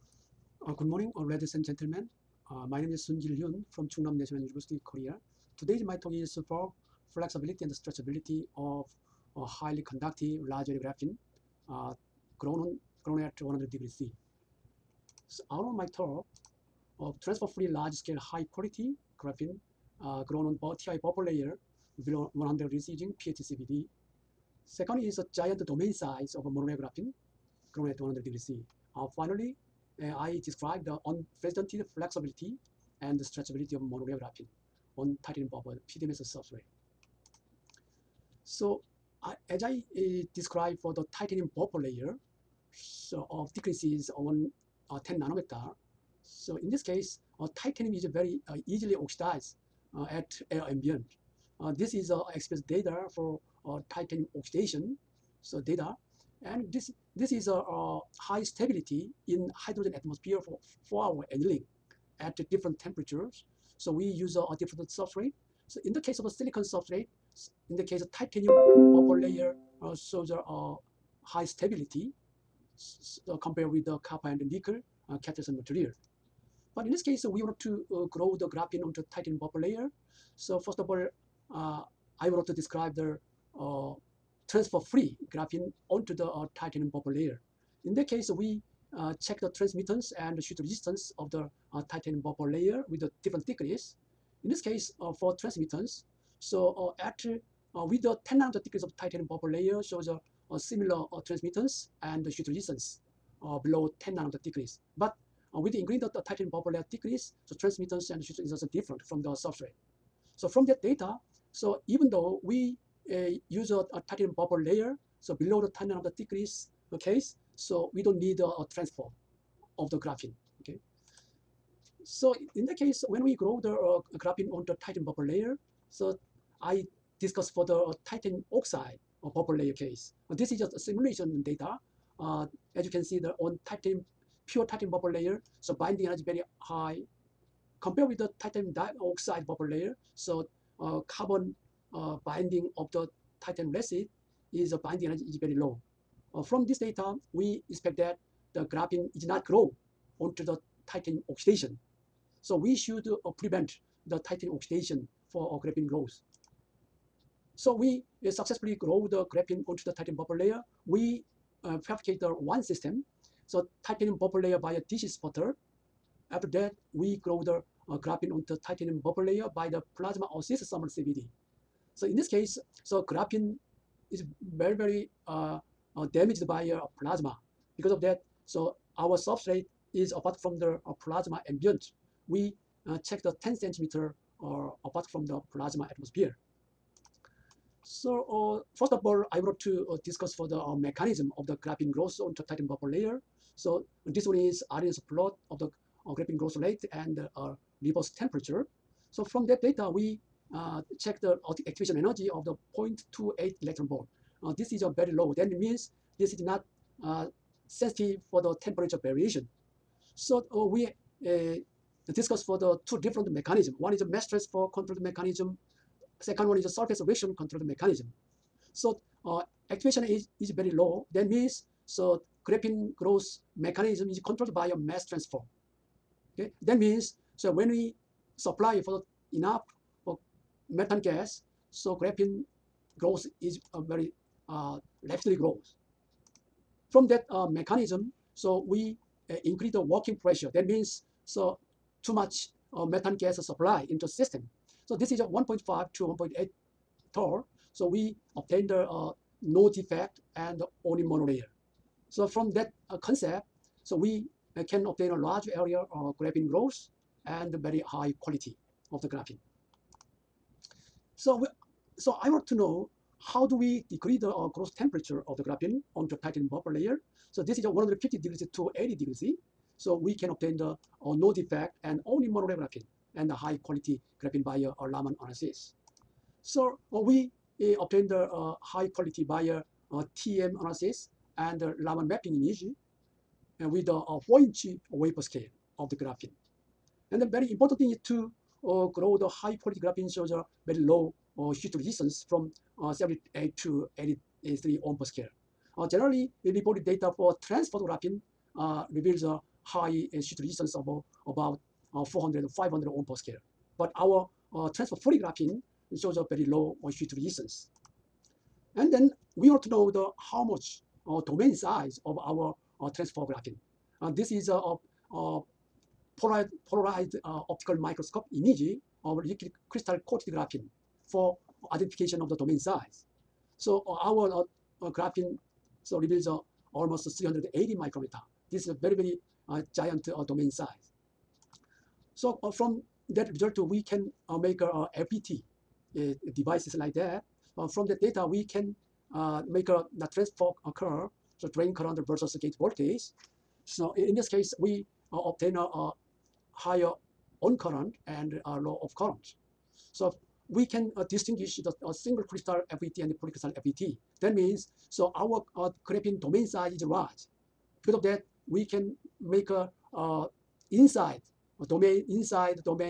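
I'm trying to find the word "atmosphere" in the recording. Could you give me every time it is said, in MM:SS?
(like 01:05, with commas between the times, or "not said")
00:59, 03:05.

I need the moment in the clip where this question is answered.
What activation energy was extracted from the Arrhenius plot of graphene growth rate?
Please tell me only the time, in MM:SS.
03:22.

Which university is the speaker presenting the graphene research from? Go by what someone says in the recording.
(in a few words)
Chungnam National University.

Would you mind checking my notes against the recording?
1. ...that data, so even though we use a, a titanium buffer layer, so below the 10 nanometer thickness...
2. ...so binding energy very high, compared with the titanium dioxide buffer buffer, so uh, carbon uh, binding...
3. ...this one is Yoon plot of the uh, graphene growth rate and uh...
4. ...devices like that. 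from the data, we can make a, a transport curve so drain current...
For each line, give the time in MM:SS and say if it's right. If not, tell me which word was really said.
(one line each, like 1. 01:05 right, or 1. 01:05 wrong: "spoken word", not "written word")
1. 01:50 right
2. 02:15 wrong: "layer", not "buffer"
3. 03:14 wrong: "Arrhenius", not "Yoon"
4. 05:36 right.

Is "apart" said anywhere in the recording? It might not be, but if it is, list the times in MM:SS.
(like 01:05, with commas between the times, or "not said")
03:00, 03:04.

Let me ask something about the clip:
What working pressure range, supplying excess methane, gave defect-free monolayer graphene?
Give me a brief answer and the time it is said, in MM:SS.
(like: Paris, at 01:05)
1.5 to 1.8 torr, at 04:05.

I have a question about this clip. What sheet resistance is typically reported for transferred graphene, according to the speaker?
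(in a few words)
400 or 500 ohm per square.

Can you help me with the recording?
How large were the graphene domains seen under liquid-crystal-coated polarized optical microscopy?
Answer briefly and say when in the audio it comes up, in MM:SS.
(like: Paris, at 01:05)
380 micrometers, at 05:27.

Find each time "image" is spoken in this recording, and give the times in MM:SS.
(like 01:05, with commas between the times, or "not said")
04:42, 05:18.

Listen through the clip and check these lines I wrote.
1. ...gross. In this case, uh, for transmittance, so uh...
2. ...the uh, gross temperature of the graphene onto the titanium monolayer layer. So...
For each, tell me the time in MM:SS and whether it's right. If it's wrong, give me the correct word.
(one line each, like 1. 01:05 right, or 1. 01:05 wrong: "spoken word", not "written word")
1. 01:33 wrong: "thickness", not "gross"
2. 04:24 wrong: "buffer", not "monolayer".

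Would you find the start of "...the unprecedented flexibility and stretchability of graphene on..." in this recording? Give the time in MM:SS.
00:30.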